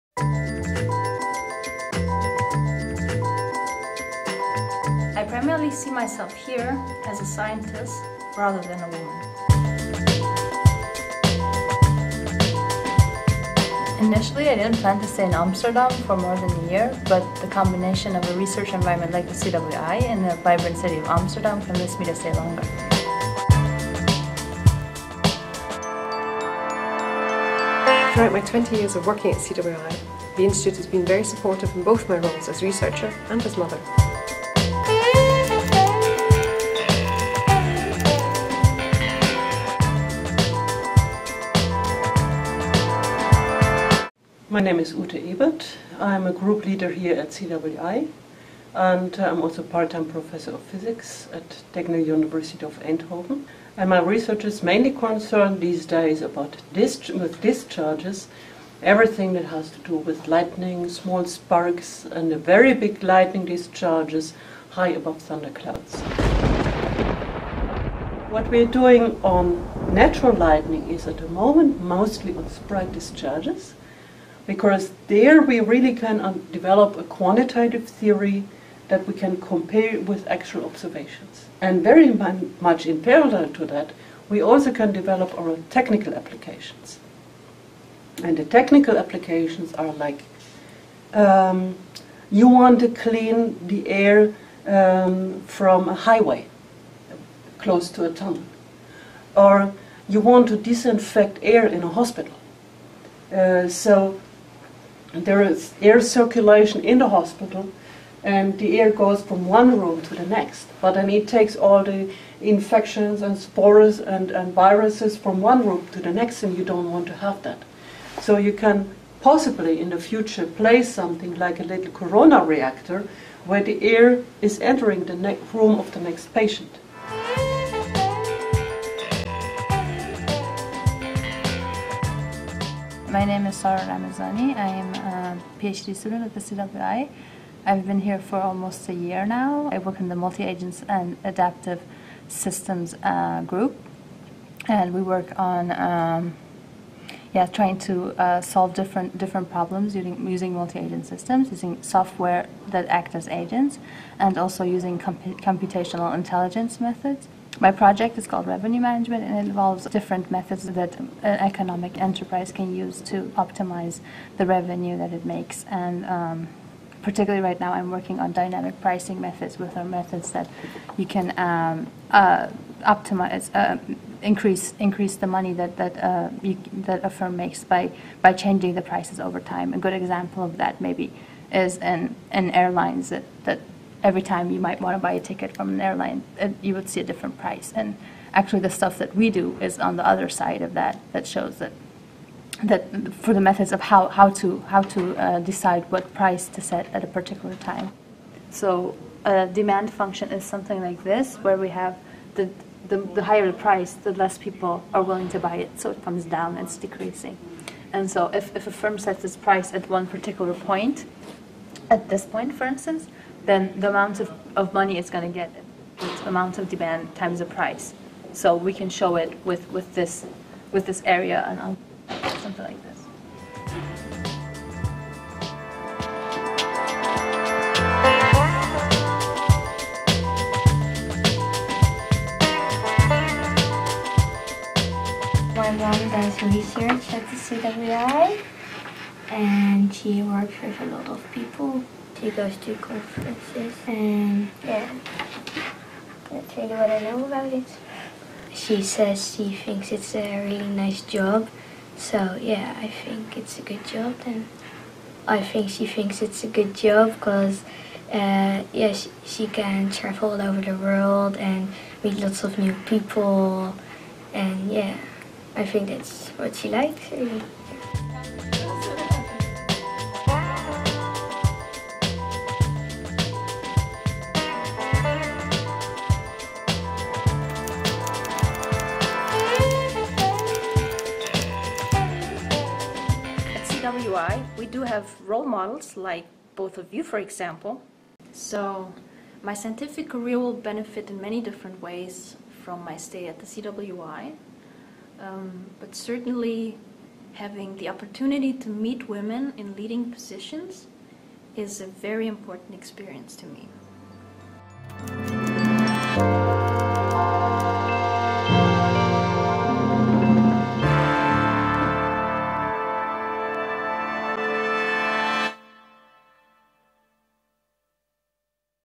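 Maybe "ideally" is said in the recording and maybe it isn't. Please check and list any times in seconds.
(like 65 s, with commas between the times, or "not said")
not said.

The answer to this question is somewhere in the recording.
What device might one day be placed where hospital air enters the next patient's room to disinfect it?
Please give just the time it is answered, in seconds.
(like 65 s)
121 s.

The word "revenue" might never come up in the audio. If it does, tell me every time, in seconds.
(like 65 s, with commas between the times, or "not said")
158 s, 164 s.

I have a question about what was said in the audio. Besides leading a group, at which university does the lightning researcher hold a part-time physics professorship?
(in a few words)
Technical University of Eindhoven.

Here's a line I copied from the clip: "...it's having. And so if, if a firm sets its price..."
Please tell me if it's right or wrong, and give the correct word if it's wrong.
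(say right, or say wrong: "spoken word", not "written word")
wrong: "decreasing", not "having".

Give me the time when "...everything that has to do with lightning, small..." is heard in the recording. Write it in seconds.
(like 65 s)
58 s.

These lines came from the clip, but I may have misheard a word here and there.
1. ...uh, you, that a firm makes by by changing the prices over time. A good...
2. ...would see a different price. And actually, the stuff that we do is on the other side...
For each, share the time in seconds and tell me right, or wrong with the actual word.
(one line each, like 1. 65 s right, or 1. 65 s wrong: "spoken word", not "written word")
1. 176 s right
2. 186 s right.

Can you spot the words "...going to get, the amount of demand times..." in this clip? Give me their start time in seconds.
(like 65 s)
215 s.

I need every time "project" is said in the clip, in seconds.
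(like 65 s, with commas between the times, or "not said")
157 s.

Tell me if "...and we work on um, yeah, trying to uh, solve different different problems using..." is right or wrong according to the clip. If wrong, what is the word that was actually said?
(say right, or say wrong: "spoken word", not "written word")
right.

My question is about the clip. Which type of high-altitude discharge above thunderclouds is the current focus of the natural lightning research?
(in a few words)
Sprite discharges.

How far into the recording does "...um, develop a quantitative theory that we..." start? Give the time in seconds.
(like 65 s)
76 s.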